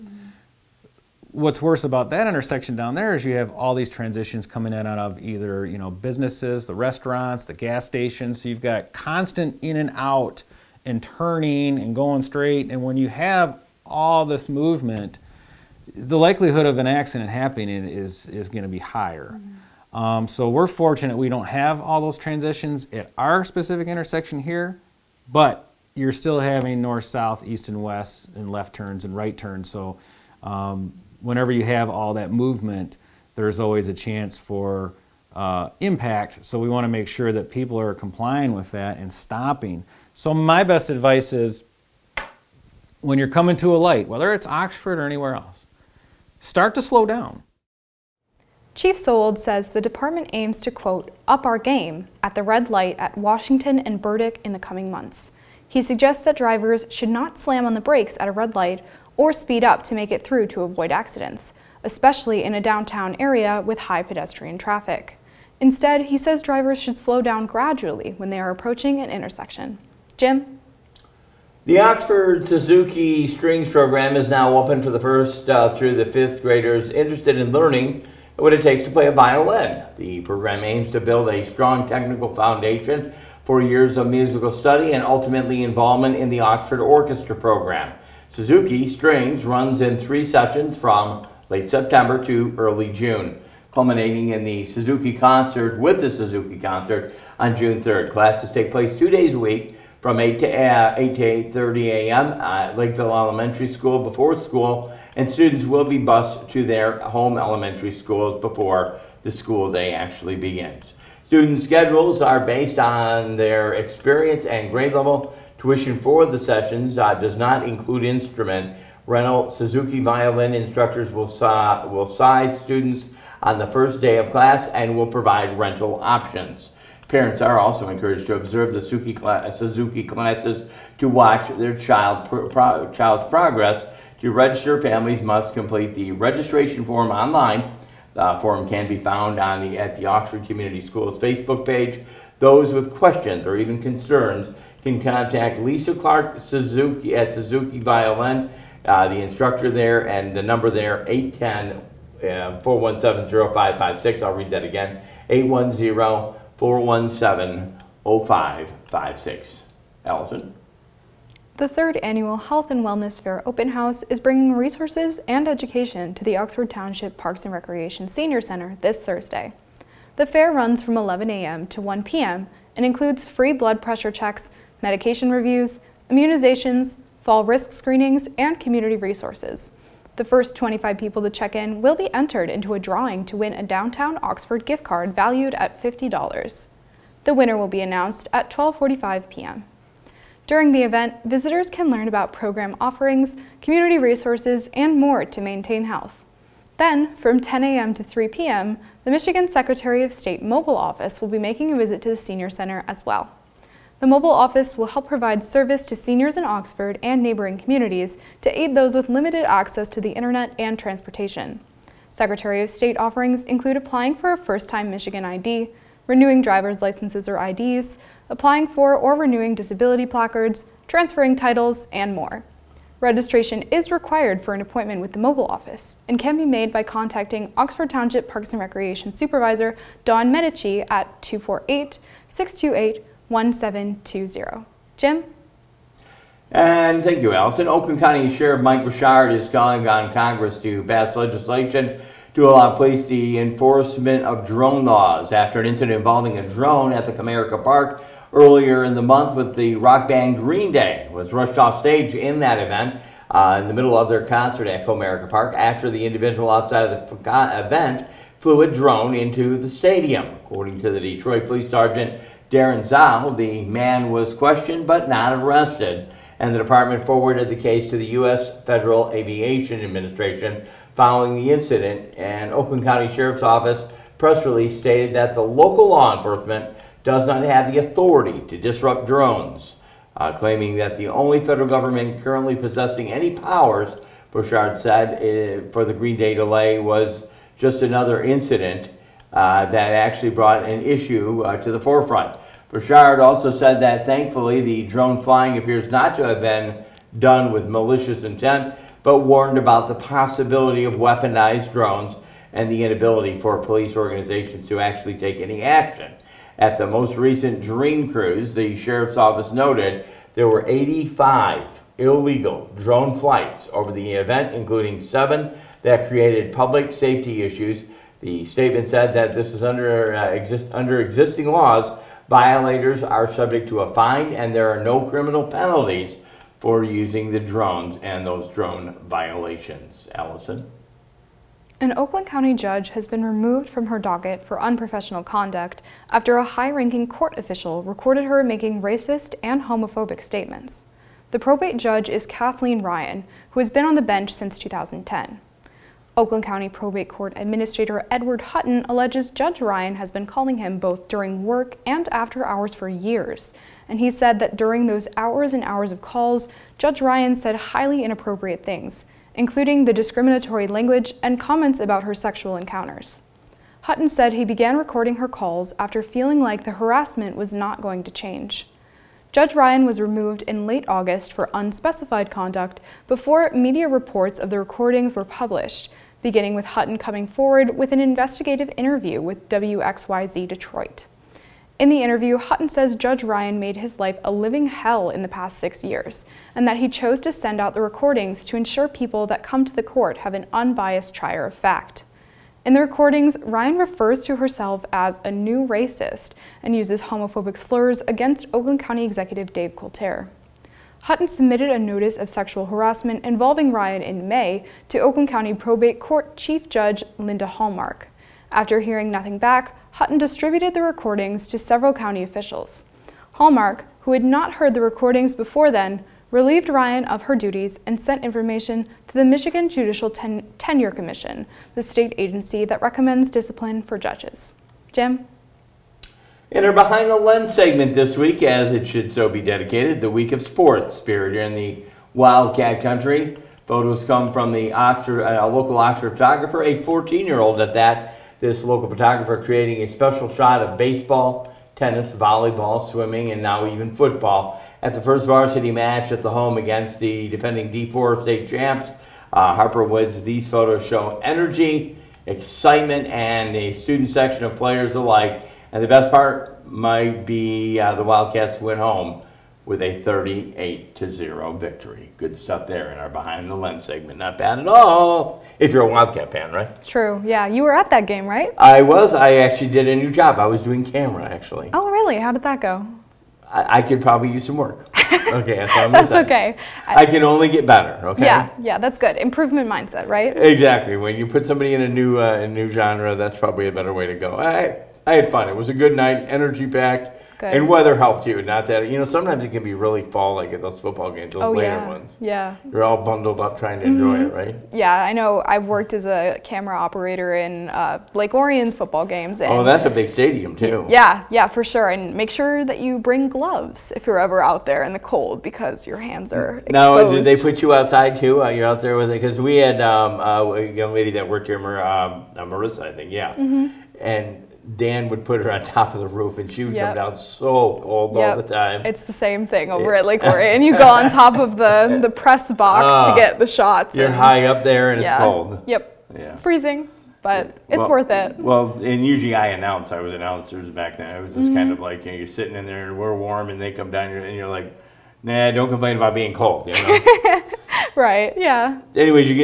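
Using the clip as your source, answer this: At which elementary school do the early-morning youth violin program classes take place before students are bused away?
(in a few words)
Lakeville Elementary School.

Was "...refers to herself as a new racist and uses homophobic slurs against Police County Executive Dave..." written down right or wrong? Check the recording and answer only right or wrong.
wrong.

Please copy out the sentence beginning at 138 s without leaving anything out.
The form can be found on the, at the Oxford Community Schools Facebook page.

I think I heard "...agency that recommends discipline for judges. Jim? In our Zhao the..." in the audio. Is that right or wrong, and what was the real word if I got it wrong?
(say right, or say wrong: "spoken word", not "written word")
wrong: "Behind", not "Zhao".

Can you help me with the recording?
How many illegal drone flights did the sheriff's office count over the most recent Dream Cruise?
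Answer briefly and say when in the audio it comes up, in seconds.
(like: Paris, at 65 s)
85, at 310 s.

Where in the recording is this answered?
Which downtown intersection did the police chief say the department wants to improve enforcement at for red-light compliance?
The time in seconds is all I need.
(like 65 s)
53 s.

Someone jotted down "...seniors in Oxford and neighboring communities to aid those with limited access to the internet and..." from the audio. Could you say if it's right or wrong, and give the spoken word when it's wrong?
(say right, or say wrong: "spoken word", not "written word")
right.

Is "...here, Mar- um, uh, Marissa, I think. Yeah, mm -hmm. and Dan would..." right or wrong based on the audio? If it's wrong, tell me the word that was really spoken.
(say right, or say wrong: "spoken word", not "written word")
right.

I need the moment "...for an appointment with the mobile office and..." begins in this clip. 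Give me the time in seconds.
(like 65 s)
224 s.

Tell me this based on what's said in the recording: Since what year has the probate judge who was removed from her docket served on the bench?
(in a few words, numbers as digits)
2010.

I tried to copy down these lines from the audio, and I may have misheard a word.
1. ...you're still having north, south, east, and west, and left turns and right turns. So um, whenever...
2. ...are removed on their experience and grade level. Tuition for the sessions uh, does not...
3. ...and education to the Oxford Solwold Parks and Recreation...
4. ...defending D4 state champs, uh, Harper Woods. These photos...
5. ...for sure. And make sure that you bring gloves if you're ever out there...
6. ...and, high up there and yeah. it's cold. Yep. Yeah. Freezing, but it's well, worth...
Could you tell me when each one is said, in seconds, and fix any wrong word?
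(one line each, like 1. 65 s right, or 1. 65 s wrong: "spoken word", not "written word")
1. 25 s right
2. 112 s wrong: "based", not "removed"
3. 165 s wrong: "Township", not "Solwold"
4. 447 s right
5. 501 s right
6. 524 s right.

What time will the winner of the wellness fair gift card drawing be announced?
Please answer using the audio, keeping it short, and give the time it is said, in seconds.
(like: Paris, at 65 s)
12:45 p.m., at 188 s.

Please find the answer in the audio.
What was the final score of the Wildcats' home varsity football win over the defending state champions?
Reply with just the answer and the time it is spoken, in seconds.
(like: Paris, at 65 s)
38 to 0, at 460 s.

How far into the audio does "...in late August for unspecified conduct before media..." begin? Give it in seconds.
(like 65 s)
370 s.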